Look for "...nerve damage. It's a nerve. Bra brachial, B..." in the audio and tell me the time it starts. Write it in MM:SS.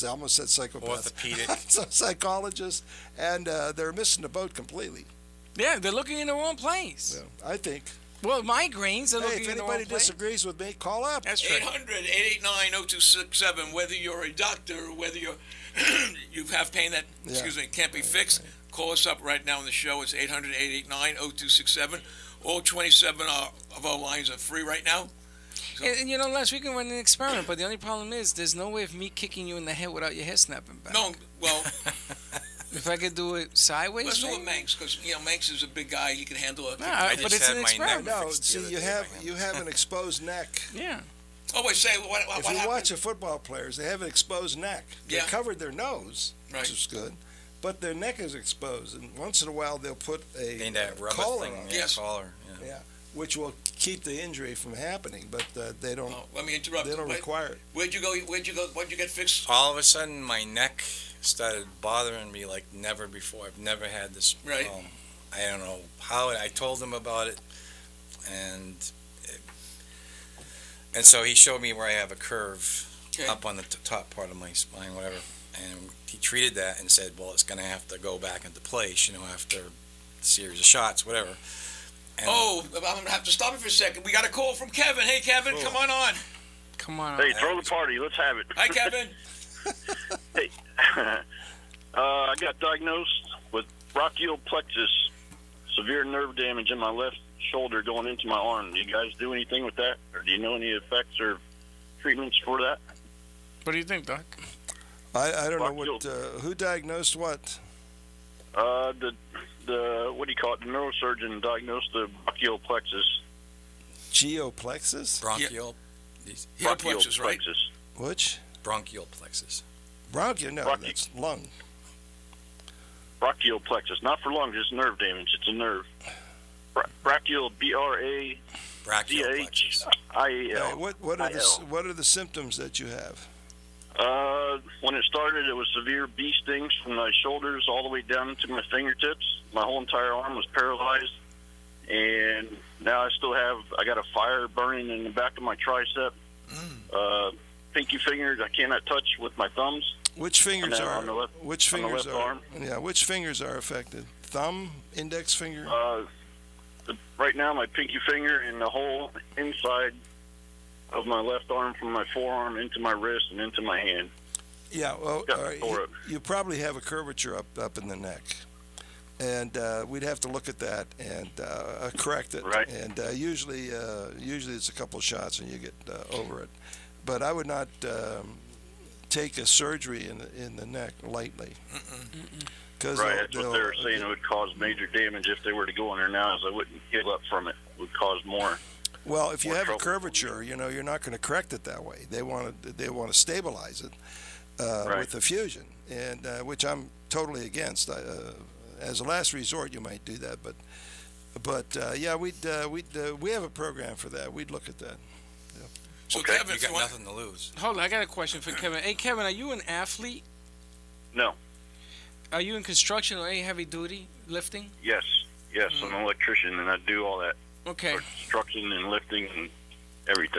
02:04.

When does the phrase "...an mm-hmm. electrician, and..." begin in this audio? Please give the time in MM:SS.
03:35.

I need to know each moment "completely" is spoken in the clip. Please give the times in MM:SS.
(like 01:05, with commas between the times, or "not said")
00:04.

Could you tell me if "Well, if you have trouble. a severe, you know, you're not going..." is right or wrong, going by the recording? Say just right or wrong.
wrong.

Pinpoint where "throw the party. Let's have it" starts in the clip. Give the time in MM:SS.
01:27.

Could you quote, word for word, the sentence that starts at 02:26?
Uh, pinky fingers I cannot touch with my thumbs.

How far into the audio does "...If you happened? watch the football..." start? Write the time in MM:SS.
00:42.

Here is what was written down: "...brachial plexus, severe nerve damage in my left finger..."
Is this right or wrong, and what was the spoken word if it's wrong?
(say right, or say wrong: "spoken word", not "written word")
wrong: "shoulder", not "finger".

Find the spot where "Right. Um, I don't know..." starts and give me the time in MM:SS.
01:04.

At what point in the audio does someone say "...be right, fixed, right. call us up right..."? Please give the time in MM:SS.
00:17.